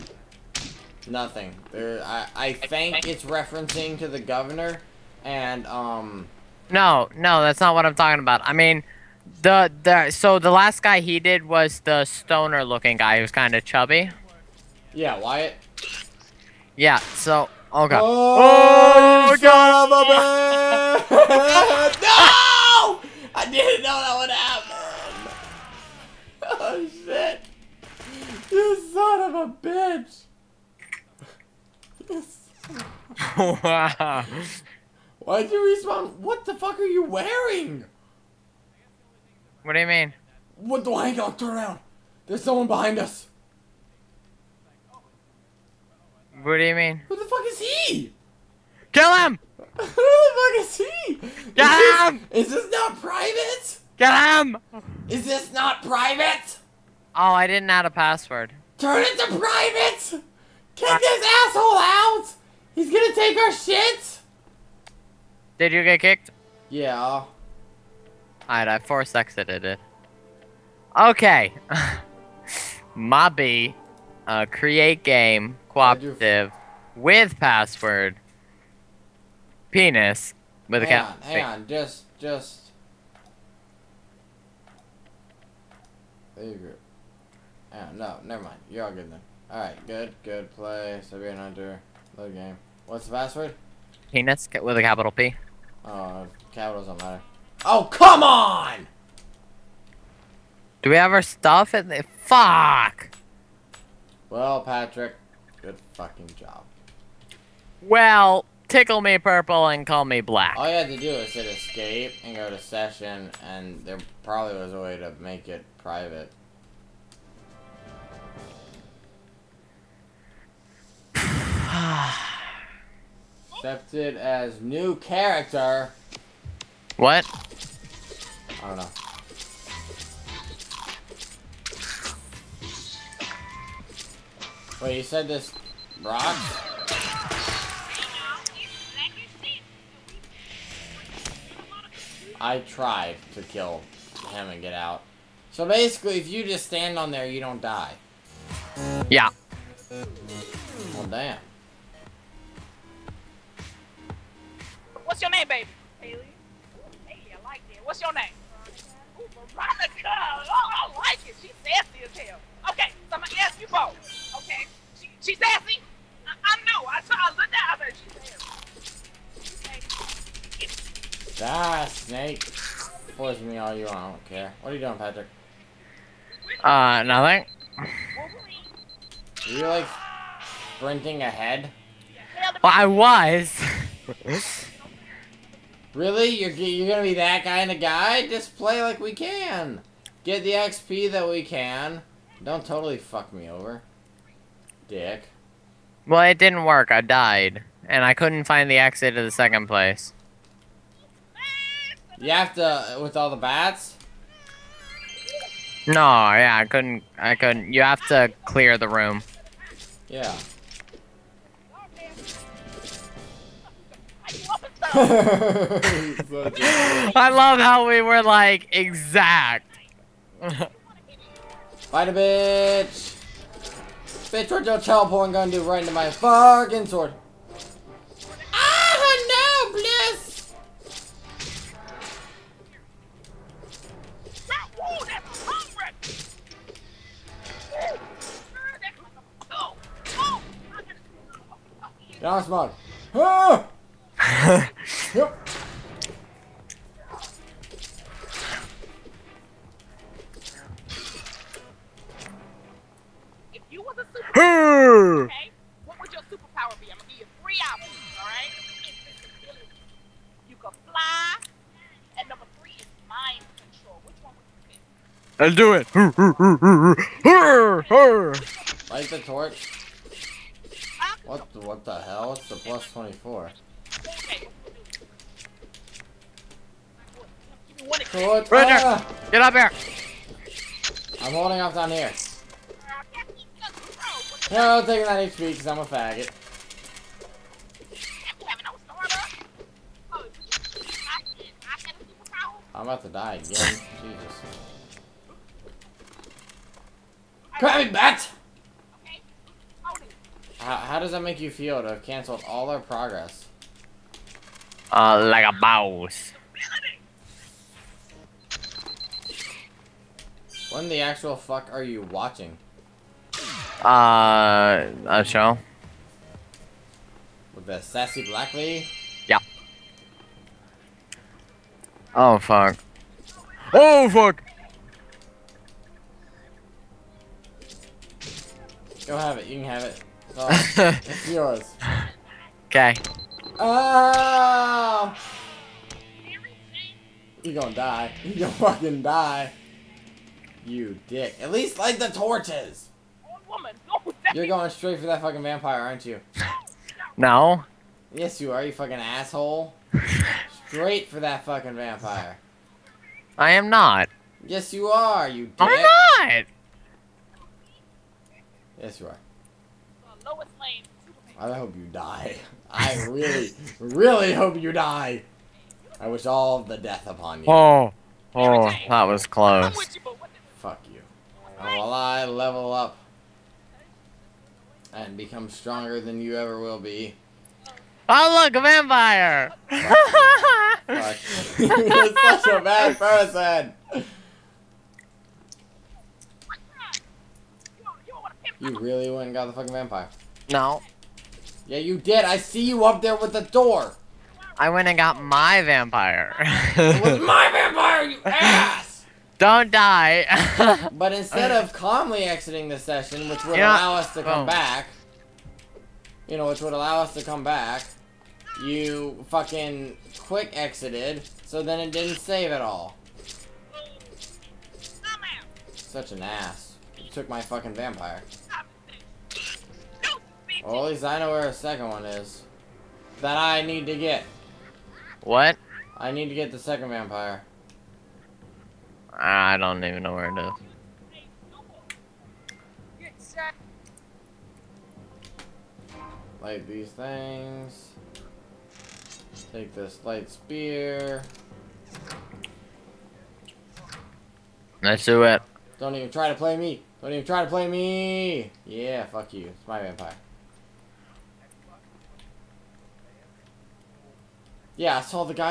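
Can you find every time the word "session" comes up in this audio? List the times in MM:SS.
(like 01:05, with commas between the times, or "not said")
01:52, 06:42.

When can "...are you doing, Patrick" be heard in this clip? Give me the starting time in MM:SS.
02:54.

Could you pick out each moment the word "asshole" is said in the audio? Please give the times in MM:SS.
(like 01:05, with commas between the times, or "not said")
01:01, 05:48.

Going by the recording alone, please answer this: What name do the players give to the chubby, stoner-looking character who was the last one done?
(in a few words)
Wyatt.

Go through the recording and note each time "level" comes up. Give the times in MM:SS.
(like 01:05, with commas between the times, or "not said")
06:12.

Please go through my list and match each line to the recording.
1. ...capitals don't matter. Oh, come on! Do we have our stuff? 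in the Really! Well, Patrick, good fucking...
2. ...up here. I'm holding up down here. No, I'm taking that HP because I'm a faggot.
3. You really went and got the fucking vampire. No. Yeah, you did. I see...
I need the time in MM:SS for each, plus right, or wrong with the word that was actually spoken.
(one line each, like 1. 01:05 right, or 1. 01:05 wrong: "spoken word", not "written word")
1. 01:36 wrong: "Fuck", not "Really"
2. 04:39 right
3. 06:28 right.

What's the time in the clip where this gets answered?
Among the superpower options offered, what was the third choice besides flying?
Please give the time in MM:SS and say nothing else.
04:23.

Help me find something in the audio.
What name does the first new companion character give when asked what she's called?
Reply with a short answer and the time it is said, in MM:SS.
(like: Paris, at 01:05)
Haley, at 02:35.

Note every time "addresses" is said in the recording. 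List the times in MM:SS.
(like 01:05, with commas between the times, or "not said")
not said.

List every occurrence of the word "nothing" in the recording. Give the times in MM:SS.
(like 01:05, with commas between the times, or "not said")
00:01, 02:57.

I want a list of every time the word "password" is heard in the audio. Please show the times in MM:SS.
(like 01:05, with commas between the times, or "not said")
00:57, 01:17, 01:33.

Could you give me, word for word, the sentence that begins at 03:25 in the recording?
No, yeah, I couldn't, I couldn't.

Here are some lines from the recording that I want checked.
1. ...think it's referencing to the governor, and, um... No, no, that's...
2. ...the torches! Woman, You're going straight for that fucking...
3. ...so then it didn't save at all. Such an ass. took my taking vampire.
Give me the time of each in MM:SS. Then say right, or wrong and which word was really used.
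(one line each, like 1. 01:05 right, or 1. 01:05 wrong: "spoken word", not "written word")
1. 00:02 right
2. 05:41 right
3. 06:51 wrong: "fucking", not "taking".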